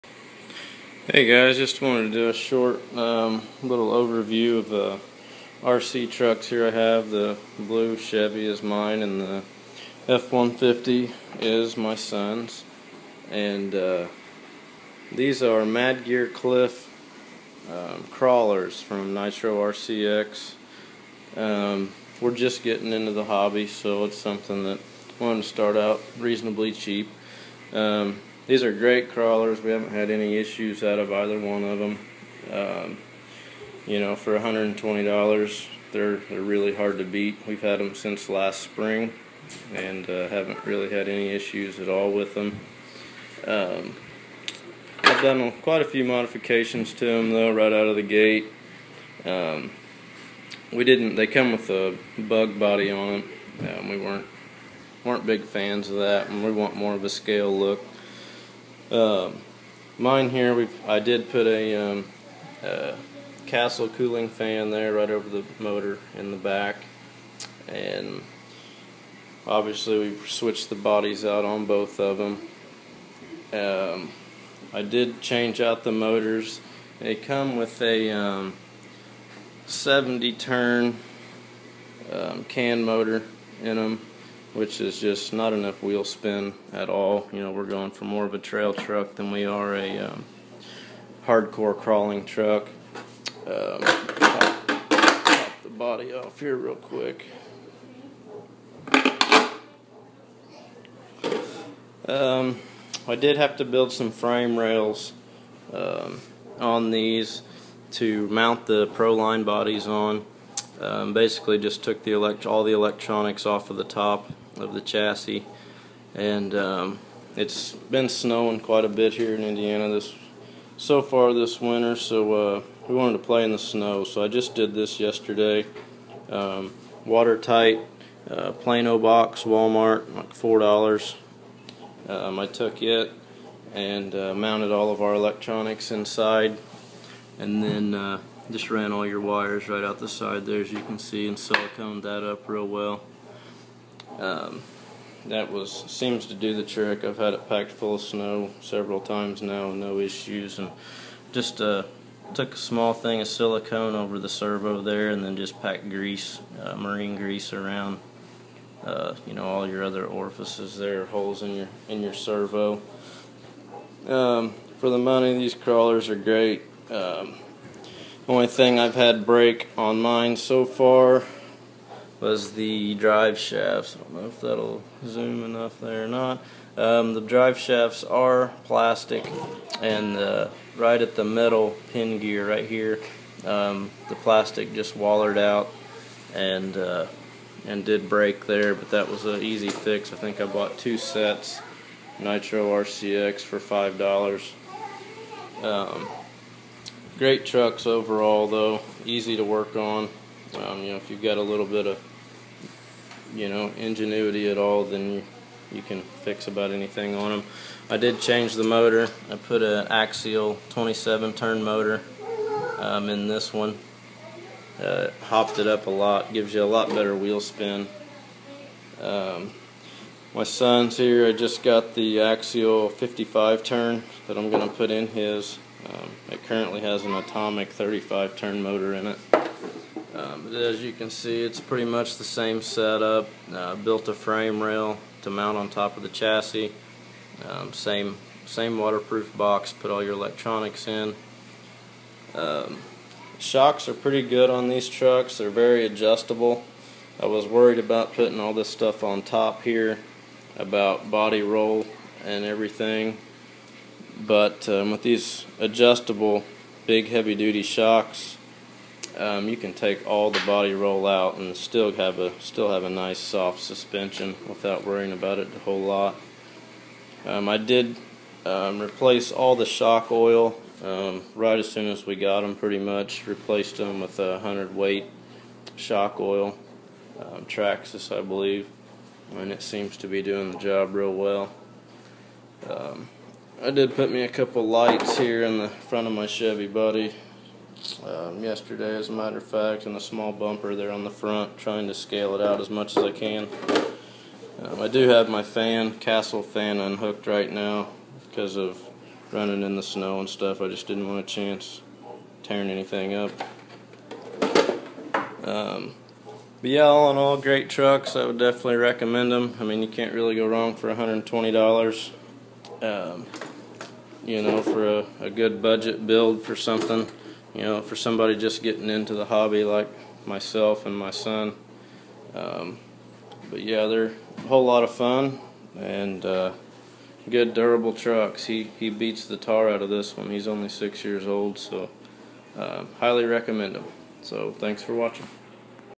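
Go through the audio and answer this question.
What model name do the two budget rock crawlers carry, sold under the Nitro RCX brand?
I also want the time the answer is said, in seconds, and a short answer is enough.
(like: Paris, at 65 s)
MadGear Cliff, at 15 s.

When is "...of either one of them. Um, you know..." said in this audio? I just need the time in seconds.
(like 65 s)
30 s.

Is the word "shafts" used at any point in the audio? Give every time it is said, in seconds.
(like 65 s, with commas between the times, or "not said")
173 s, 177 s.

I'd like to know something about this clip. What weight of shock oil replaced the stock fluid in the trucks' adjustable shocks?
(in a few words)
100.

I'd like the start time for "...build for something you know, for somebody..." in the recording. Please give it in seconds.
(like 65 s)
316 s.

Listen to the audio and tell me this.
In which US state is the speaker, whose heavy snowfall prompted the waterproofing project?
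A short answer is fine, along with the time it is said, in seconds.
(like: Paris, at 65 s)
Indiana, at 119 s.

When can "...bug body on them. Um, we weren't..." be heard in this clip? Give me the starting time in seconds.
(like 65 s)
52 s.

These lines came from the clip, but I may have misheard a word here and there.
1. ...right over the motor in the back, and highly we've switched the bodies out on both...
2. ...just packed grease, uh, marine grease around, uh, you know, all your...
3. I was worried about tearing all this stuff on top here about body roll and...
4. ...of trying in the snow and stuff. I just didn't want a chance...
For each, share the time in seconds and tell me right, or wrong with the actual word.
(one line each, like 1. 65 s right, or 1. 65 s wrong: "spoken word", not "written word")
1. 64 s wrong: "obviously", not "highly"
2. 155 s right
3. 247 s wrong: "putting", not "tearing"
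4. 298 s wrong: "running", not "trying".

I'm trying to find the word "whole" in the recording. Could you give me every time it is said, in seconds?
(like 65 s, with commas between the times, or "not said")
265 s, 324 s.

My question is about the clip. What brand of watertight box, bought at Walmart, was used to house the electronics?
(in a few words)
Plano.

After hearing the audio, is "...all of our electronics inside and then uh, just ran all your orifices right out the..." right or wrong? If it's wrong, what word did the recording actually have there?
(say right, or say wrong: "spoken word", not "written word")
wrong: "wires", not "orifices".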